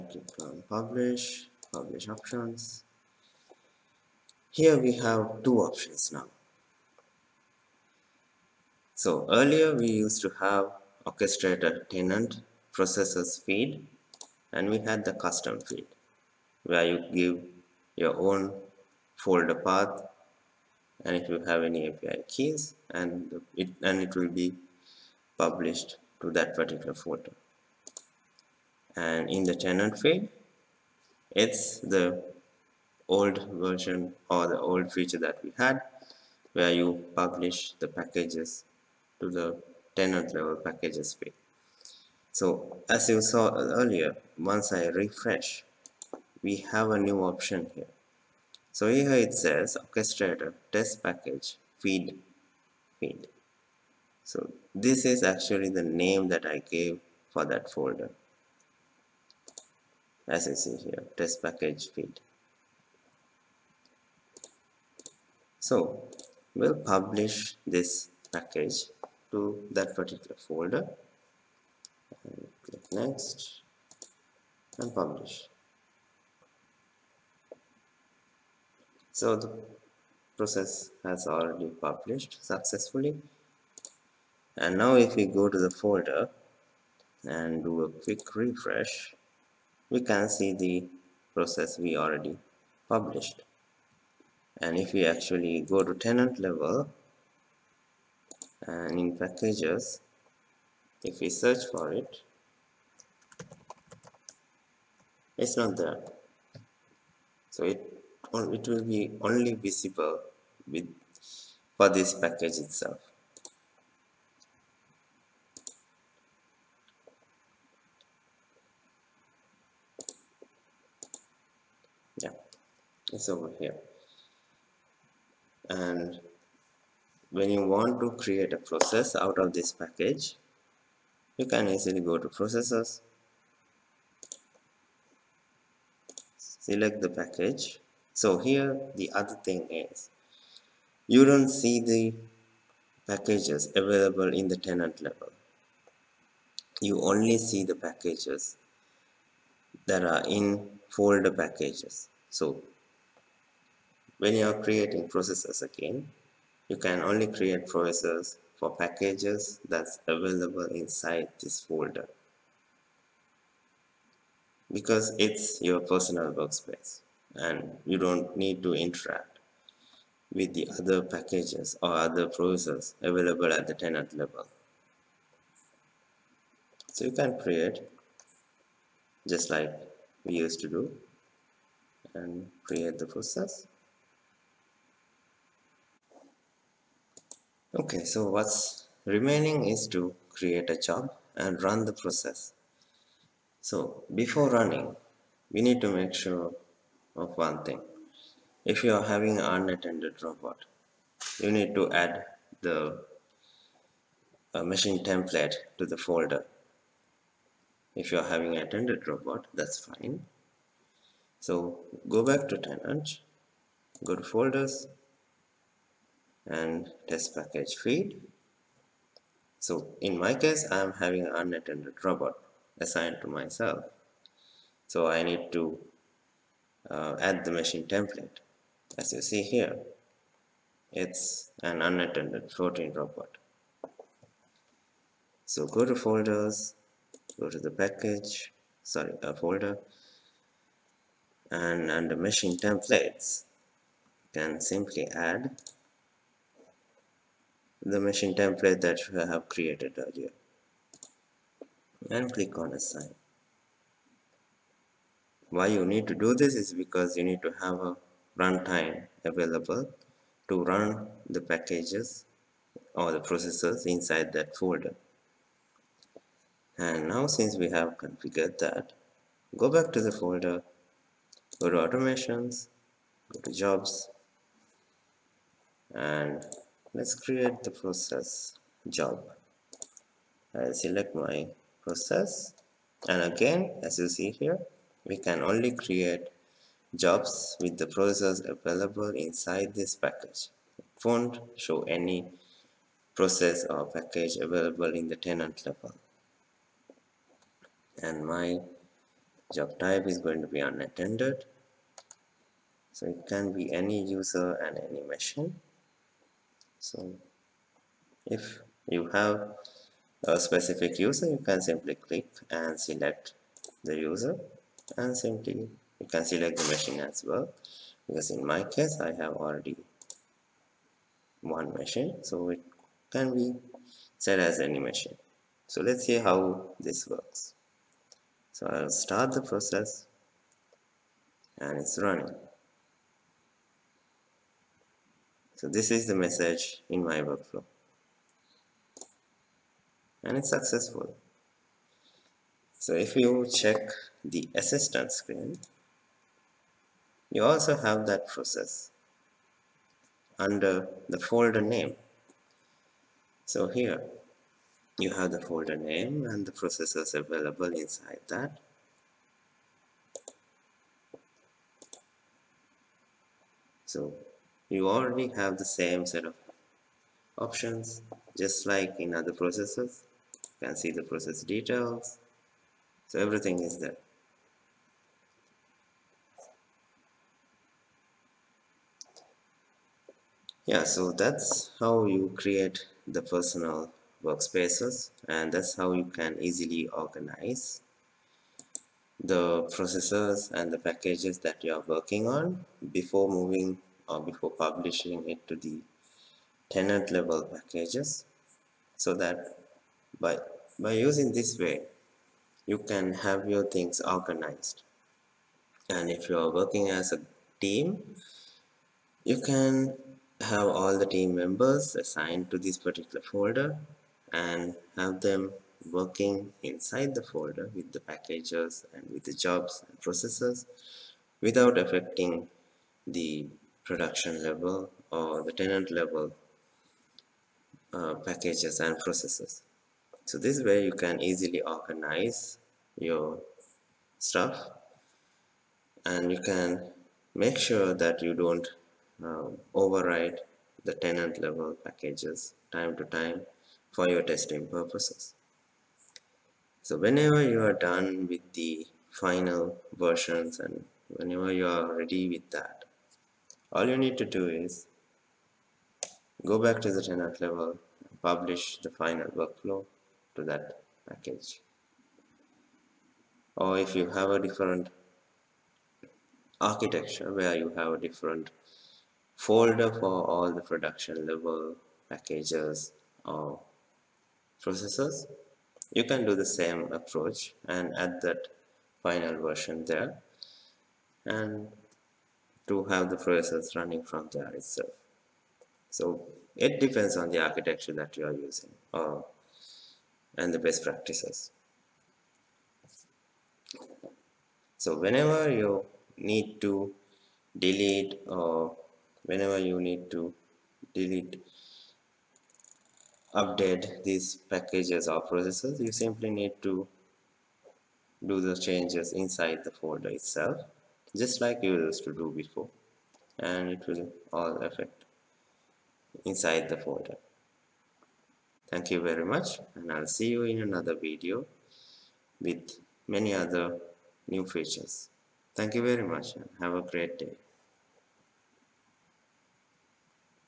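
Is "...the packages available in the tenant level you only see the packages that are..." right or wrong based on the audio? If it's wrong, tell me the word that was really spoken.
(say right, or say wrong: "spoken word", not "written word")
right.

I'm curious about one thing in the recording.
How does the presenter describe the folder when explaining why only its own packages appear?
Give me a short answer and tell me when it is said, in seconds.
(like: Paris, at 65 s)
your personal workspace, at 165 s.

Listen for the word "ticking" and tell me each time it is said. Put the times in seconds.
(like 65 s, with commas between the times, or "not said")
not said.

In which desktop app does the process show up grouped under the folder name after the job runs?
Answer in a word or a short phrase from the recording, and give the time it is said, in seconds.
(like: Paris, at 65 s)
the assistant, at 344 s.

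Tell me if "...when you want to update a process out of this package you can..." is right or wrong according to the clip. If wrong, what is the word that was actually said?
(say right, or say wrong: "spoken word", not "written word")
wrong: "create", not "update".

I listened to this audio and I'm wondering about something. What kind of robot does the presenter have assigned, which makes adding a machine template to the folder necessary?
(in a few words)
unattended floating robot.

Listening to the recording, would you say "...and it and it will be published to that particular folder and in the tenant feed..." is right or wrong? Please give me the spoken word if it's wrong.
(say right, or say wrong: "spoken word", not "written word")
right.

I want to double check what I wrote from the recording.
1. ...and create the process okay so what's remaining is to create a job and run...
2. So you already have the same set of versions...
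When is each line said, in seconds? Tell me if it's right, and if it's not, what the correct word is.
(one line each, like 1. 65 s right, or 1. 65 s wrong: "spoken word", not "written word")
1. 182 s right
2. 363 s wrong: "options", not "versions".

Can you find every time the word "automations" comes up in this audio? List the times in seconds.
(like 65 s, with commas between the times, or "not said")
271 s.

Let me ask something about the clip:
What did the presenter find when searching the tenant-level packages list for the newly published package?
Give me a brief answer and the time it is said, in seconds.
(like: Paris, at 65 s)
it's not there, at 105 s.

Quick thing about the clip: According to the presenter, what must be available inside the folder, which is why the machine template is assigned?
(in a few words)
a runtime.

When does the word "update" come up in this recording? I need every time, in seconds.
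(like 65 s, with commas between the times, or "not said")
503 s.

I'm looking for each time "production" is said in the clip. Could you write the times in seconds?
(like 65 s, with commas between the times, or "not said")
423 s, 470 s.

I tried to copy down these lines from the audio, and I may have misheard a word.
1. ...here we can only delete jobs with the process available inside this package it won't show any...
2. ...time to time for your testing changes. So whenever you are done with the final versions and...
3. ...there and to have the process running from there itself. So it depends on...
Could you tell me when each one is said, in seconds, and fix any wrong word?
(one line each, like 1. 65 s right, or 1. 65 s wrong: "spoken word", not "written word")
1. 284 s wrong: "create", not "delete"
2. 442 s wrong: "purposes", not "changes"
3. 479 s right.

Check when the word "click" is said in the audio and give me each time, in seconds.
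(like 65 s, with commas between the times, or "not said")
0 s, 72 s, 252 s, 312 s.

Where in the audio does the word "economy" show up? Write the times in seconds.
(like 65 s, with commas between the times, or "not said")
not said.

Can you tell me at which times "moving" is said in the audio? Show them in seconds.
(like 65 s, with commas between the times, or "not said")
393 s.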